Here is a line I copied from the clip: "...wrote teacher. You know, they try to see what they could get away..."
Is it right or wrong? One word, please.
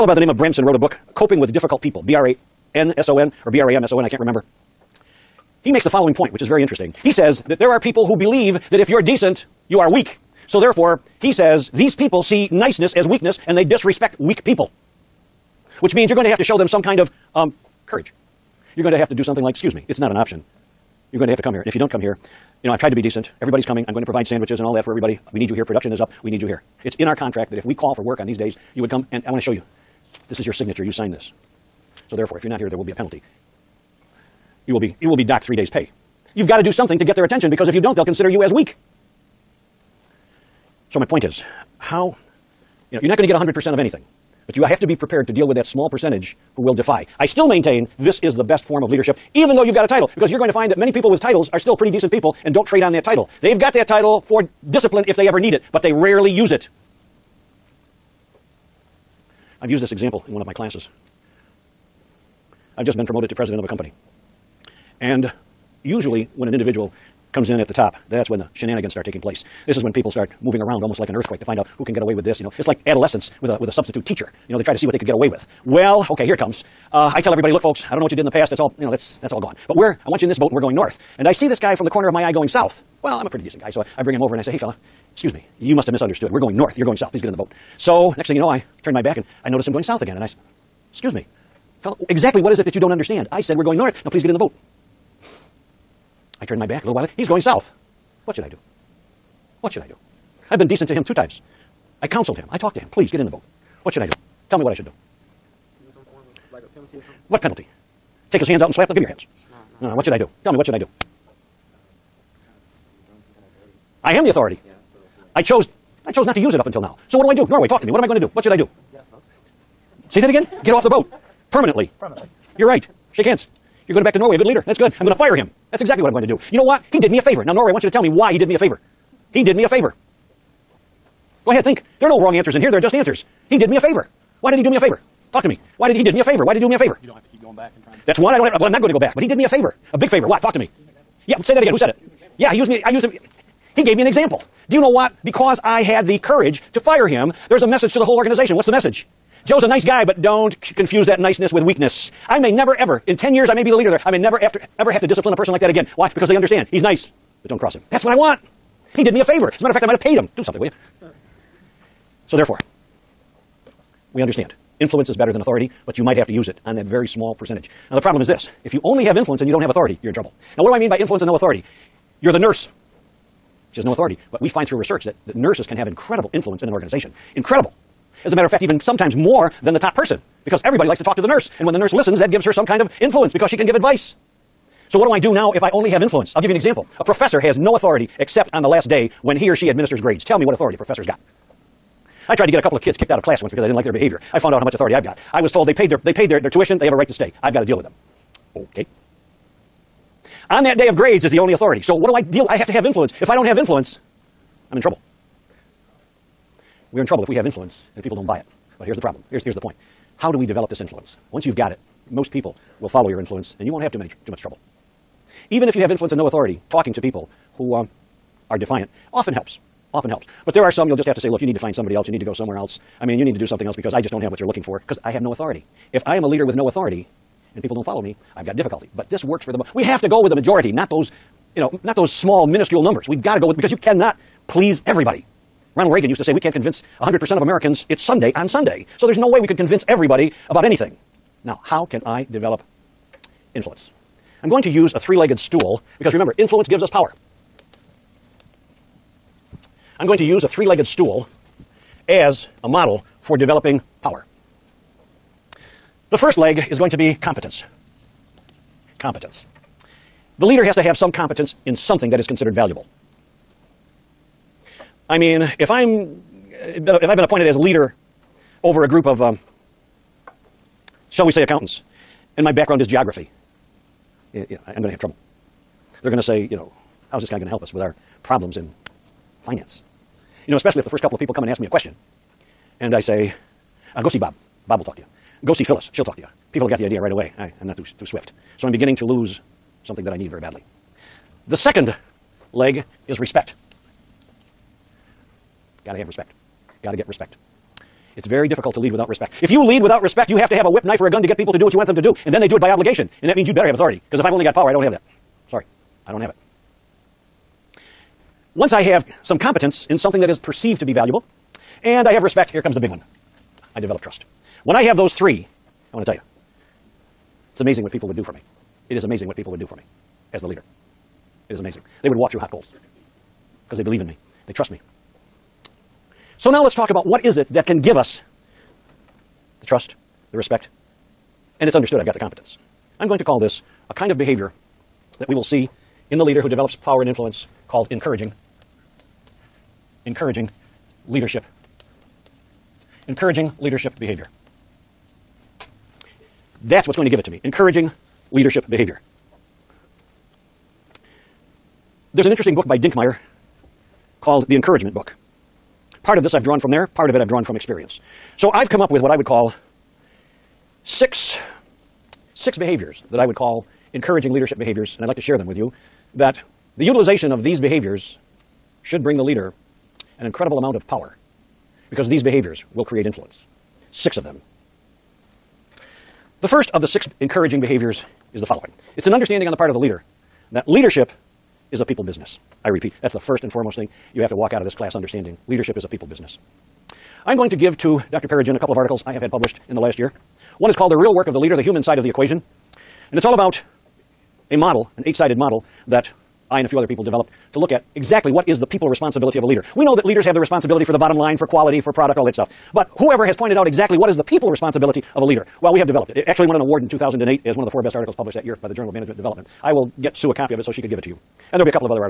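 wrong.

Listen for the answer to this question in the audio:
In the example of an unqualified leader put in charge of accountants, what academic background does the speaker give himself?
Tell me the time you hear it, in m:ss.
4:32.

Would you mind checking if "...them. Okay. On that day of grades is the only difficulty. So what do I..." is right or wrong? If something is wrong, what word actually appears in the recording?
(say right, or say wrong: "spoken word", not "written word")
wrong: "authority", not "difficulty".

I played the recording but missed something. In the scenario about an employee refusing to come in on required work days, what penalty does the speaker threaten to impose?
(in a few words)
docked 3 days' pay.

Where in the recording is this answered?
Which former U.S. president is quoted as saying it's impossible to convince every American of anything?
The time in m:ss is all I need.
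3:55.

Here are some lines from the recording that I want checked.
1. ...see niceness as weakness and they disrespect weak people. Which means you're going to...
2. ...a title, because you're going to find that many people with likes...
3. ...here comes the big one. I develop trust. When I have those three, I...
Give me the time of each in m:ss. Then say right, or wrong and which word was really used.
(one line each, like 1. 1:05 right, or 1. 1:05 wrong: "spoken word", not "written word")
1. 0:12 right
2. 0:49 wrong: "titles", not "likes"
3. 5:12 right.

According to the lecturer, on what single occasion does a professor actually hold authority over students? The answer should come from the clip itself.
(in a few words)
the last day.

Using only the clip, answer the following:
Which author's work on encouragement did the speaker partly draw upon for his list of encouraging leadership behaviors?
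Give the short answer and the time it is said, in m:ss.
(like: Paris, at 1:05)
Dinkmeyer, at 5:52.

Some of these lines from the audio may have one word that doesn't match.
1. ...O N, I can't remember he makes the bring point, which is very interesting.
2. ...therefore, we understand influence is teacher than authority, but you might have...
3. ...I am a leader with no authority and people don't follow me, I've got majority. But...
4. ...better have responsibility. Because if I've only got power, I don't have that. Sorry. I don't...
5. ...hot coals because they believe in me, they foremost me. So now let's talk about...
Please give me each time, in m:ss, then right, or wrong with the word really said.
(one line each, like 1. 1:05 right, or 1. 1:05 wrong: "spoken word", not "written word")
1. 0:03 wrong: "following", not "bring"
2. 2:42 wrong: "better", not "teacher"
3. 3:46 wrong: "difficulty", not "majority"
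4. 5:03 wrong: "authority", not "responsibility"
5. 5:22 wrong: "trust", not "foremost".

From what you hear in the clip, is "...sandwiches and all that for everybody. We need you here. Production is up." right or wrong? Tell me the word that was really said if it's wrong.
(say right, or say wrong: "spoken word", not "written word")
right.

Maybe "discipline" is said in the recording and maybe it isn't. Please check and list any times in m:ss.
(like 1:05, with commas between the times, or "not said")
0:54, 2:35.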